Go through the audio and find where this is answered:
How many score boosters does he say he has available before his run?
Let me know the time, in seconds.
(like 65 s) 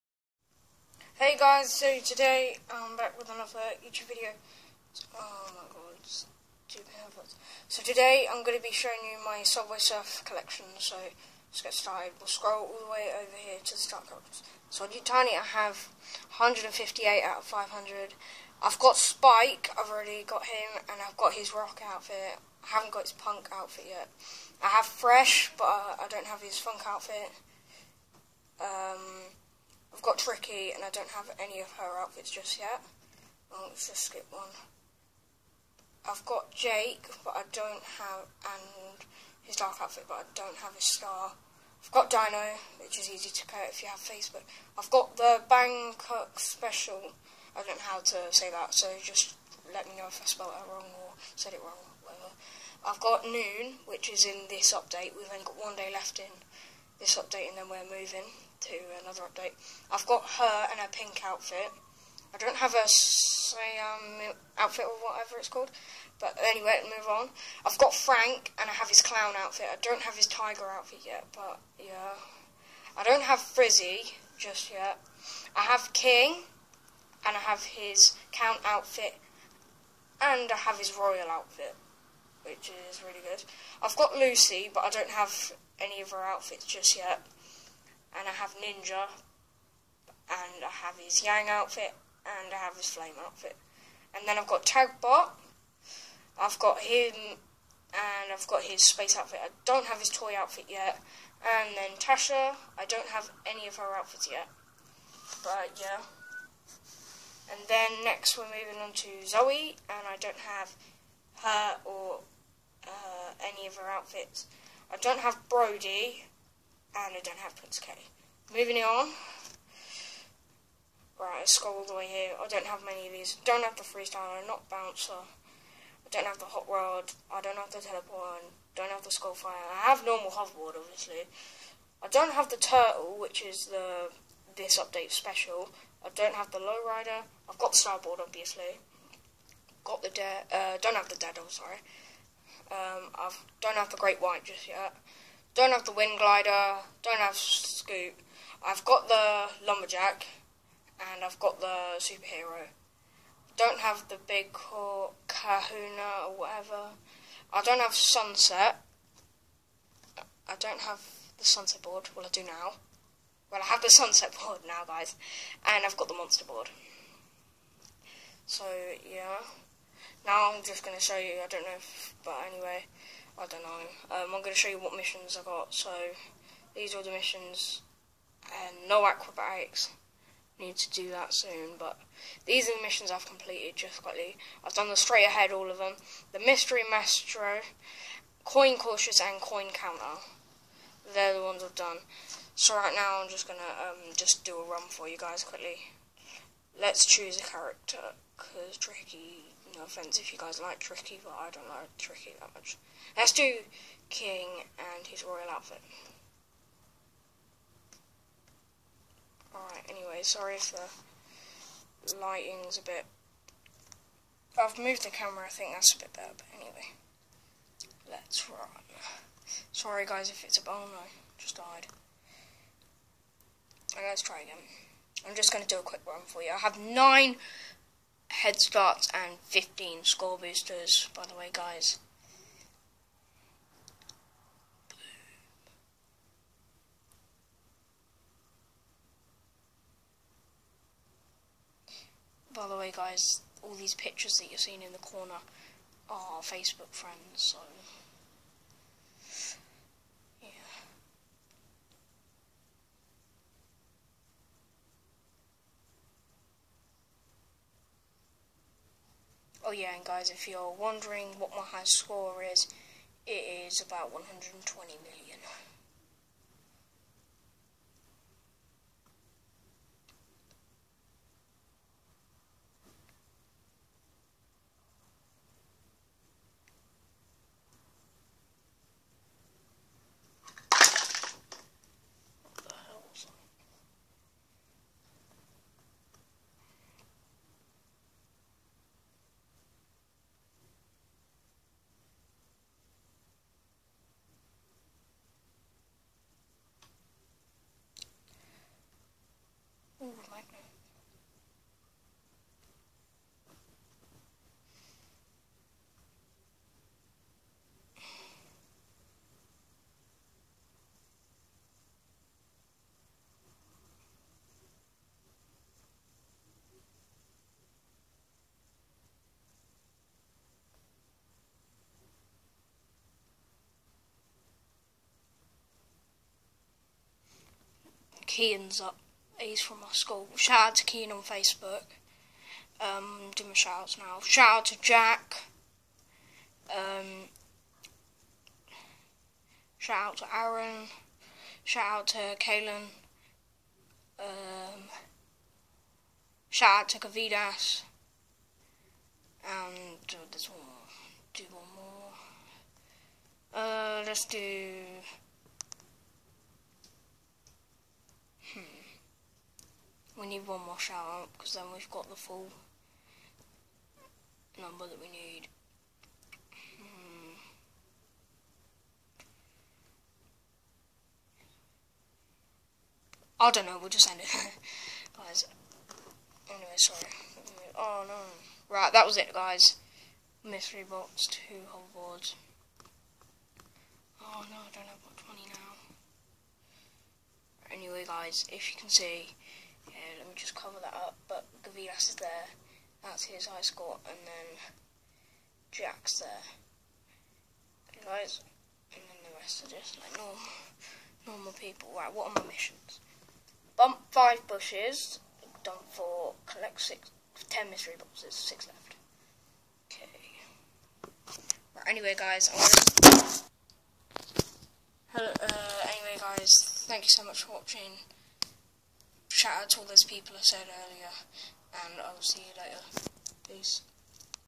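229 s.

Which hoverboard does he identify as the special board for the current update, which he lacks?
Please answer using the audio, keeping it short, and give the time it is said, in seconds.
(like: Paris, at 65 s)
the turtle, at 132 s.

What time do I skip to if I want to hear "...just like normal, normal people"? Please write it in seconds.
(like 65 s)
399 s.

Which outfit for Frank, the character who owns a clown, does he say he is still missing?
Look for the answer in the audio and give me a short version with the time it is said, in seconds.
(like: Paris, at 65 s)
tiger outfit, at 70 s.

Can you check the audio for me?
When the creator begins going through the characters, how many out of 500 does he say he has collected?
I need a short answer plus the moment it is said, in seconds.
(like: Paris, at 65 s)
158, at 16 s.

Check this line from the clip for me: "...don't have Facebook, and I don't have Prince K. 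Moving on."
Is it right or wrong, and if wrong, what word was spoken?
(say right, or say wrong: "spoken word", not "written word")
wrong: "Brody", not "Facebook".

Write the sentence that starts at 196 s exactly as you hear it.
Let's choose a character because Tricky, no offense if you guys like Tricky, but I don't like Tricky that much.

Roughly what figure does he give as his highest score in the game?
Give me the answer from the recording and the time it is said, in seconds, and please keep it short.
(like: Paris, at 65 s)
120 million, at 264 s.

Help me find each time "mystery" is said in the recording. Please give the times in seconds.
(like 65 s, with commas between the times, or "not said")
186 s, 380 s, 407 s.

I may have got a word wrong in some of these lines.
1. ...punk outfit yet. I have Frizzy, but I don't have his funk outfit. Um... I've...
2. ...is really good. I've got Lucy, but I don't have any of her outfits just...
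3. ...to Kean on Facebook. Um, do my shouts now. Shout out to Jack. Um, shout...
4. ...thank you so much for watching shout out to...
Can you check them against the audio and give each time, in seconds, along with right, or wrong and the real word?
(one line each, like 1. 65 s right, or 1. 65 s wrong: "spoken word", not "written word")
1. 23 s wrong: "Fresh", not "Frizzy"
2. 82 s right
3. 330 s right
4. 416 s right.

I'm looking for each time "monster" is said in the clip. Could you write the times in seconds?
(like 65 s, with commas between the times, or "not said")
166 s.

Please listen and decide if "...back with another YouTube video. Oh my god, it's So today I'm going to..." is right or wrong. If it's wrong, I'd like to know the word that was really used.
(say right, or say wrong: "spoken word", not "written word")
right.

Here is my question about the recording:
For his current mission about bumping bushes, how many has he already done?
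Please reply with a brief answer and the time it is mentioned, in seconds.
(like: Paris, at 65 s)
4, at 405 s.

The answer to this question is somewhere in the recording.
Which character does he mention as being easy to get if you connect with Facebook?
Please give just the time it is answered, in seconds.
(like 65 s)
42 s.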